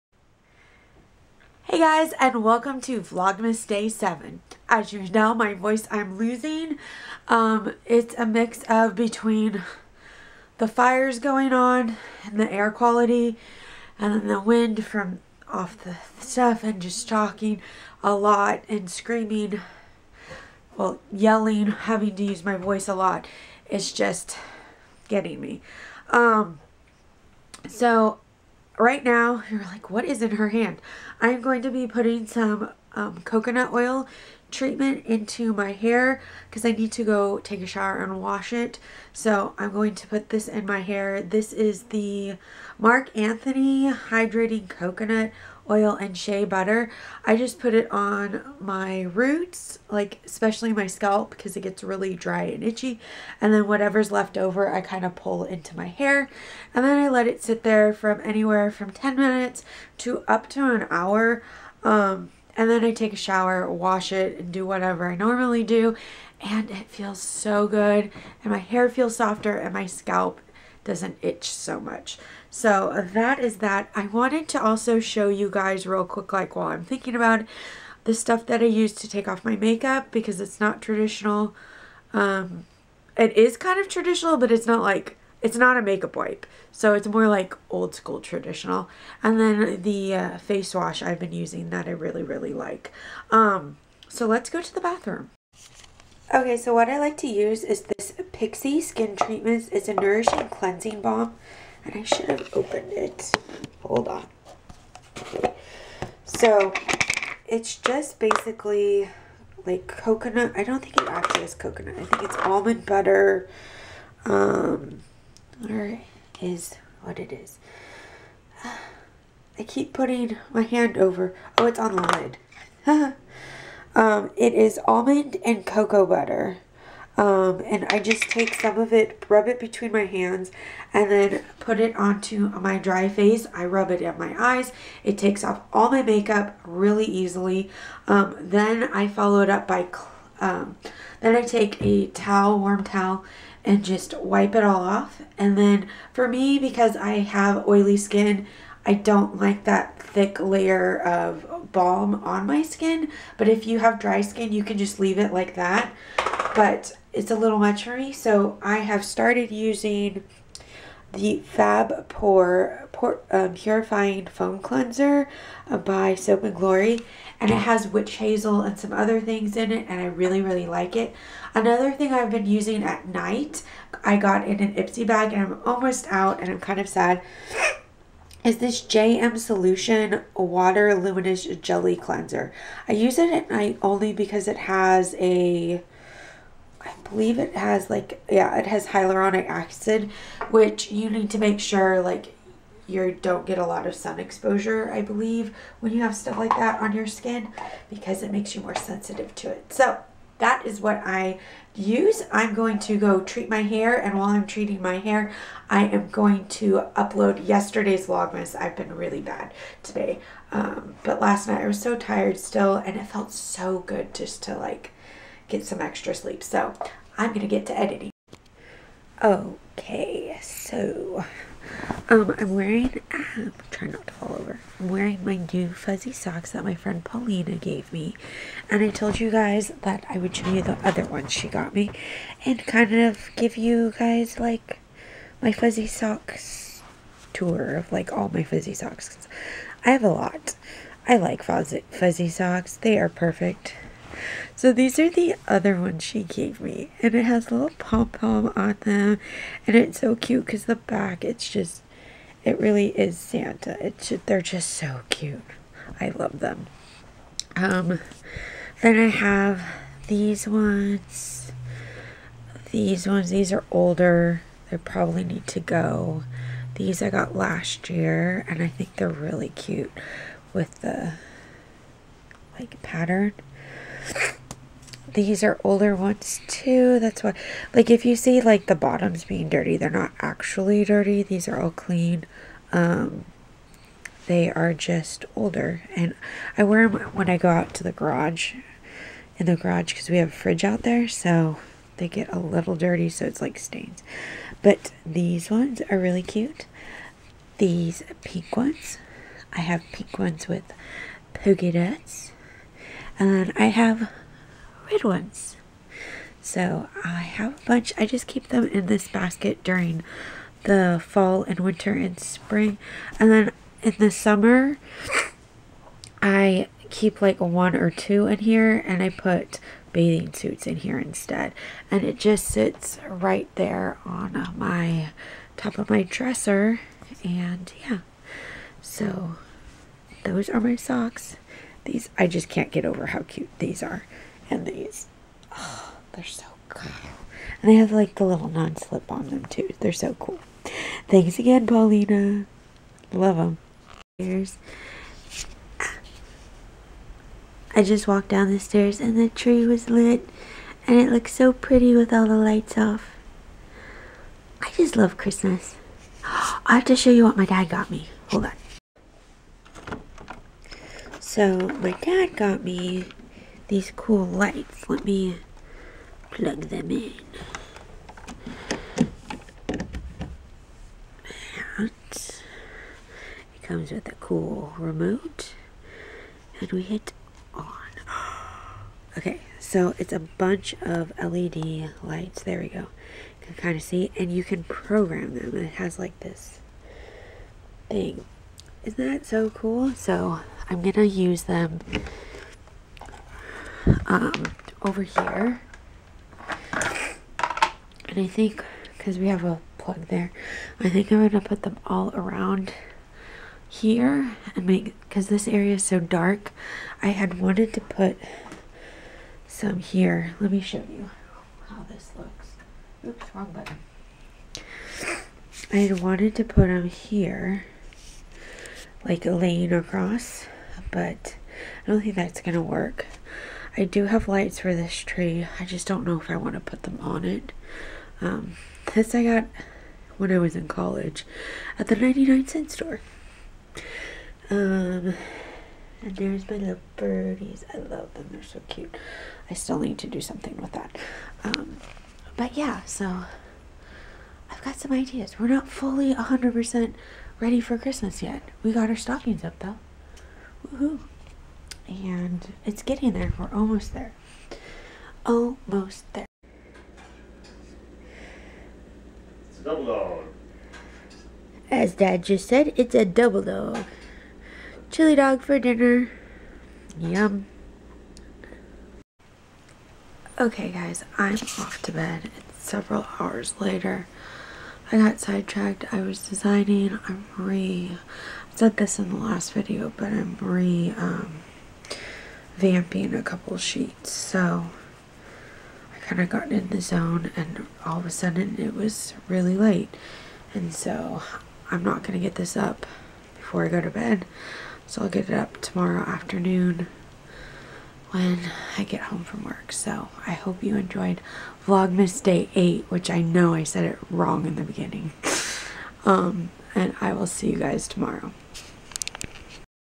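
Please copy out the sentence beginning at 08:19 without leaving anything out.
So I hope you enjoyed Vlogmas Day 8, which I know I said it wrong in the beginning.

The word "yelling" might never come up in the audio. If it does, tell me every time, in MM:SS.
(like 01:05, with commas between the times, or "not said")
00:21.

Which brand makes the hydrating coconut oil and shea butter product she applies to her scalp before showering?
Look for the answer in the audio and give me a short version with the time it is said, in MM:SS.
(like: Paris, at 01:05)
Marc Anthony, at 00:42.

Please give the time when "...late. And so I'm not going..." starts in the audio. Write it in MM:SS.
08:09.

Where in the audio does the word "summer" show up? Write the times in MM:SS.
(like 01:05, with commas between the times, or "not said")
05:14.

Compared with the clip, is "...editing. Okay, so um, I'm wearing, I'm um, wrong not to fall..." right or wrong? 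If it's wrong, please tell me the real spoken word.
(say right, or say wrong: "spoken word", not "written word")
wrong: "trying", not "wrong".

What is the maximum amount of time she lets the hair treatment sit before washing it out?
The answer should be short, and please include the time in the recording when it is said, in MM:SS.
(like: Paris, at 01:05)
an hour, at 01:00.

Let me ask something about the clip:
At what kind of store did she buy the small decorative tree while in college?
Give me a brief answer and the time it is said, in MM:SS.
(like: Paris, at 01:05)
99 cent store, at 07:11.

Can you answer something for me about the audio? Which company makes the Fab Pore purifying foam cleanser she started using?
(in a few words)
Soap and Glory.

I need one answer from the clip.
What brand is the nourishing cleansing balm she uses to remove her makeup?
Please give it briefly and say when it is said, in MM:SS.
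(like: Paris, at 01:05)
Pixi, at 01:38.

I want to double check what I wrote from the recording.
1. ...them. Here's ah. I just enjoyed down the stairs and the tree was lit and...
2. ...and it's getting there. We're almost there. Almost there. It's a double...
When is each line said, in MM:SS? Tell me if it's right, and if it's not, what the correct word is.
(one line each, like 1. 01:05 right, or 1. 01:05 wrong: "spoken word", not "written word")
1. 05:43 wrong: "walked", not "enjoyed"
2. 07:31 right.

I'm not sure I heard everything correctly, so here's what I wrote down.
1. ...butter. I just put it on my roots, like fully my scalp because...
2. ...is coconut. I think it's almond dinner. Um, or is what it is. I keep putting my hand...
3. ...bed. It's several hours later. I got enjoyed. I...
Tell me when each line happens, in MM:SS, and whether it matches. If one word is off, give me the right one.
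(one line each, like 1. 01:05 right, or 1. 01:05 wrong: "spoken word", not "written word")
1. 00:46 wrong: "especially", not "fully"
2. 01:51 wrong: "butter", not "dinner"
3. 07:51 wrong: "sidetracked", not "enjoyed".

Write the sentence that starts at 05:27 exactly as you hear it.
And yeah, so those are my socks.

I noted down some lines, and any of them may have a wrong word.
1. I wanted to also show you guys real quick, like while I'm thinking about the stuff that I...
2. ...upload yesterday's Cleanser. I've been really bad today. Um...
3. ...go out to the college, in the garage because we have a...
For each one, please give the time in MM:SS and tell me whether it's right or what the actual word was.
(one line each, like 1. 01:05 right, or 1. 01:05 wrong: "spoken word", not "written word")
1. 01:13 right
2. 03:26 wrong: "Vlogmas", not "Cleanser"
3. 04:47 wrong: "garage", not "college".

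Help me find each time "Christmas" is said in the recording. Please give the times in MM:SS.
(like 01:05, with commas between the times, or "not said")
05:55, 07:27.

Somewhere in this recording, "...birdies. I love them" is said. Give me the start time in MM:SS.
07:16.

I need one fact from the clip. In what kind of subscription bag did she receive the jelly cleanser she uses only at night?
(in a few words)
Ipsy bag.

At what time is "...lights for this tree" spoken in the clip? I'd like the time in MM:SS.
07:04.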